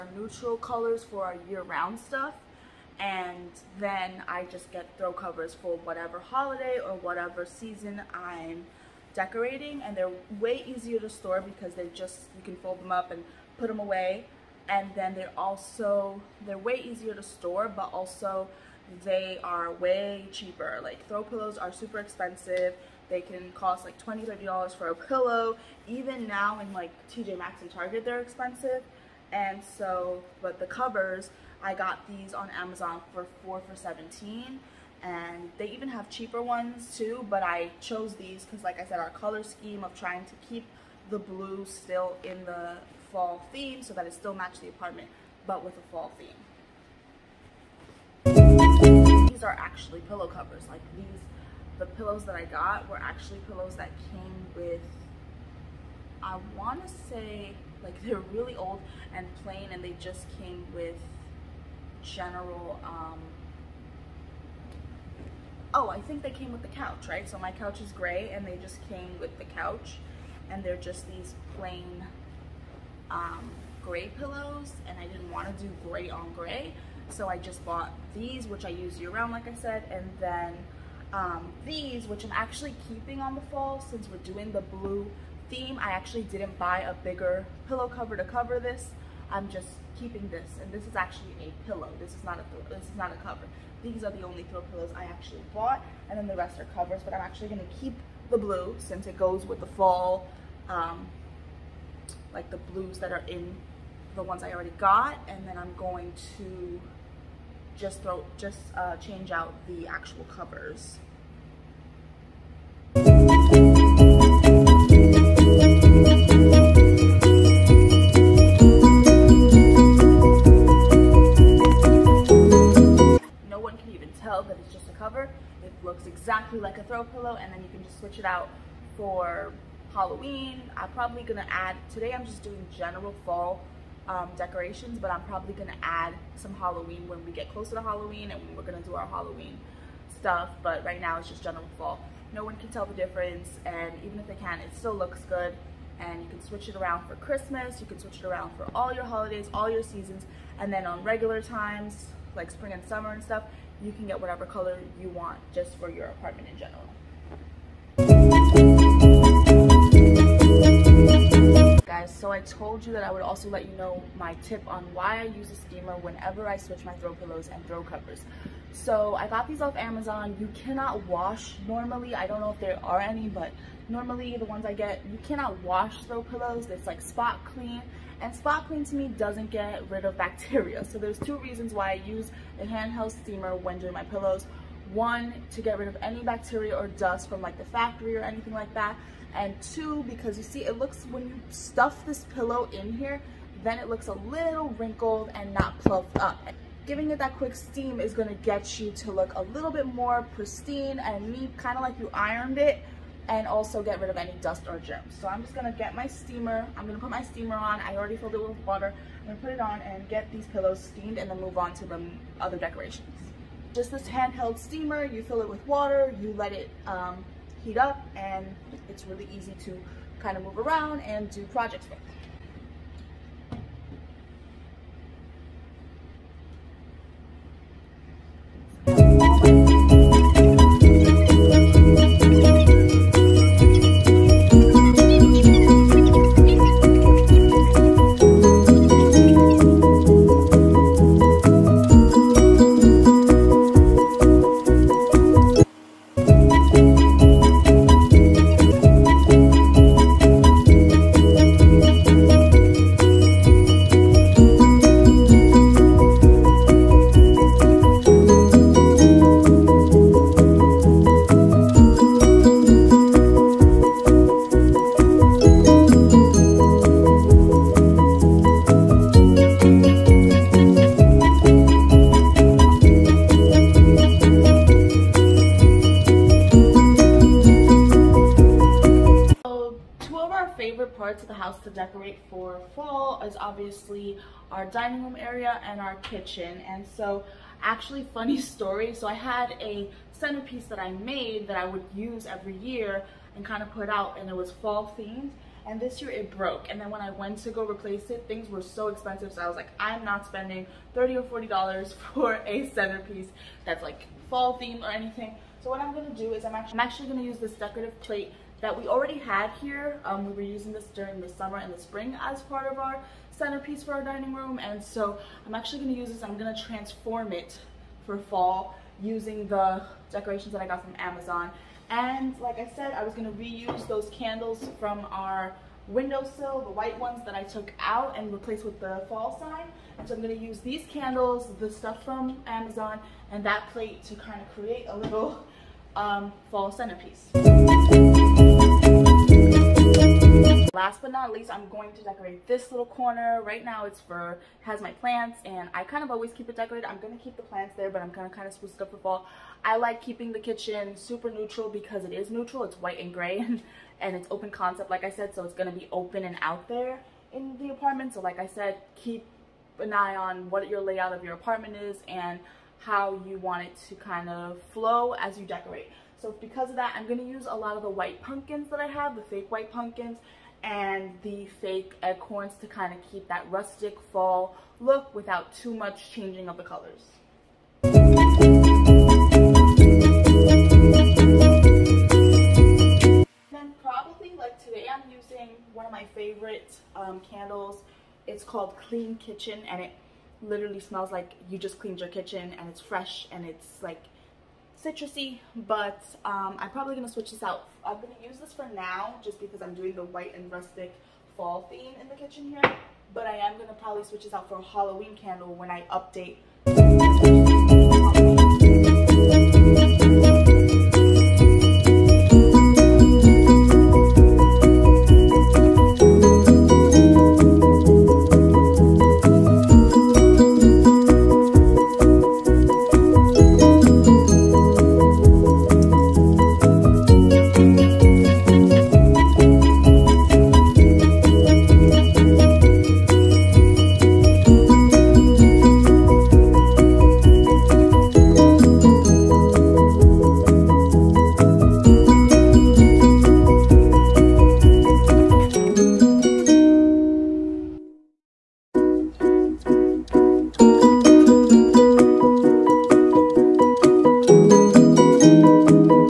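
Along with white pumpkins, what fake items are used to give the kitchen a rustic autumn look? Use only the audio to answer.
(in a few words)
Acorns.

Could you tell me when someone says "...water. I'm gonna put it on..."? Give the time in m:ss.
3:28.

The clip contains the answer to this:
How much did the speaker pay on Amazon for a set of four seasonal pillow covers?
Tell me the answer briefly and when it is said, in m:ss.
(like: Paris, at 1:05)
$17, at 0:33.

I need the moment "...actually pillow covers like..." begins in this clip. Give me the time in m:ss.
0:49.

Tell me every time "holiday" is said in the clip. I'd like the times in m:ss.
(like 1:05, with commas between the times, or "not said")
0:06, 2:29.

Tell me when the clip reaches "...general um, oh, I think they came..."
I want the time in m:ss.
1:02.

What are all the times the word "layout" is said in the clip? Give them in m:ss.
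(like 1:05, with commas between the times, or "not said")
6:00.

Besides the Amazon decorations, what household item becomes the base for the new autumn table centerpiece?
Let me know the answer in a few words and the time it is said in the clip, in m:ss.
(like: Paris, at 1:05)
Decorative plate, at 5:07.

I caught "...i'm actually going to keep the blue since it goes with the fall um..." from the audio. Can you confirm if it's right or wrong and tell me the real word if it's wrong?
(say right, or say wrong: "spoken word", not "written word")
right.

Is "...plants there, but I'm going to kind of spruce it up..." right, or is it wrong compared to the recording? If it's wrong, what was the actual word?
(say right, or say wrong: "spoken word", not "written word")
right.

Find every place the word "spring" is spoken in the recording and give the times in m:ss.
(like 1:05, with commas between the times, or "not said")
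2:32, 5:11.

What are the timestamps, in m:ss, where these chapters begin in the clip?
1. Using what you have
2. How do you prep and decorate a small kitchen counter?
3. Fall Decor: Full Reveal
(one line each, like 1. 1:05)
1. 5:08
2. 5:40
3. 7:19.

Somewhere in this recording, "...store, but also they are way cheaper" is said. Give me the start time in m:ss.
0:17.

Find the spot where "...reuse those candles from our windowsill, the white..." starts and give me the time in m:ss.
5:23.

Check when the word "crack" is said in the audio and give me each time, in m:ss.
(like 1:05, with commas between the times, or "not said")
not said.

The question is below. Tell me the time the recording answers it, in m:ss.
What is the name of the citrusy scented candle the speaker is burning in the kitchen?
6:28.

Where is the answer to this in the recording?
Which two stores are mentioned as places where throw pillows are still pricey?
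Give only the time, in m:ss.
0:27.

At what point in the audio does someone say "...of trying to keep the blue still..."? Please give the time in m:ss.
0:39.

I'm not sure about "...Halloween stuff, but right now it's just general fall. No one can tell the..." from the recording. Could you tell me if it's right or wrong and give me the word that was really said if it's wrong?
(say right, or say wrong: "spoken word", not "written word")
right.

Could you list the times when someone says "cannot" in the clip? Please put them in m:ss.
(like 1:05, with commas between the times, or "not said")
2:50, 2:55.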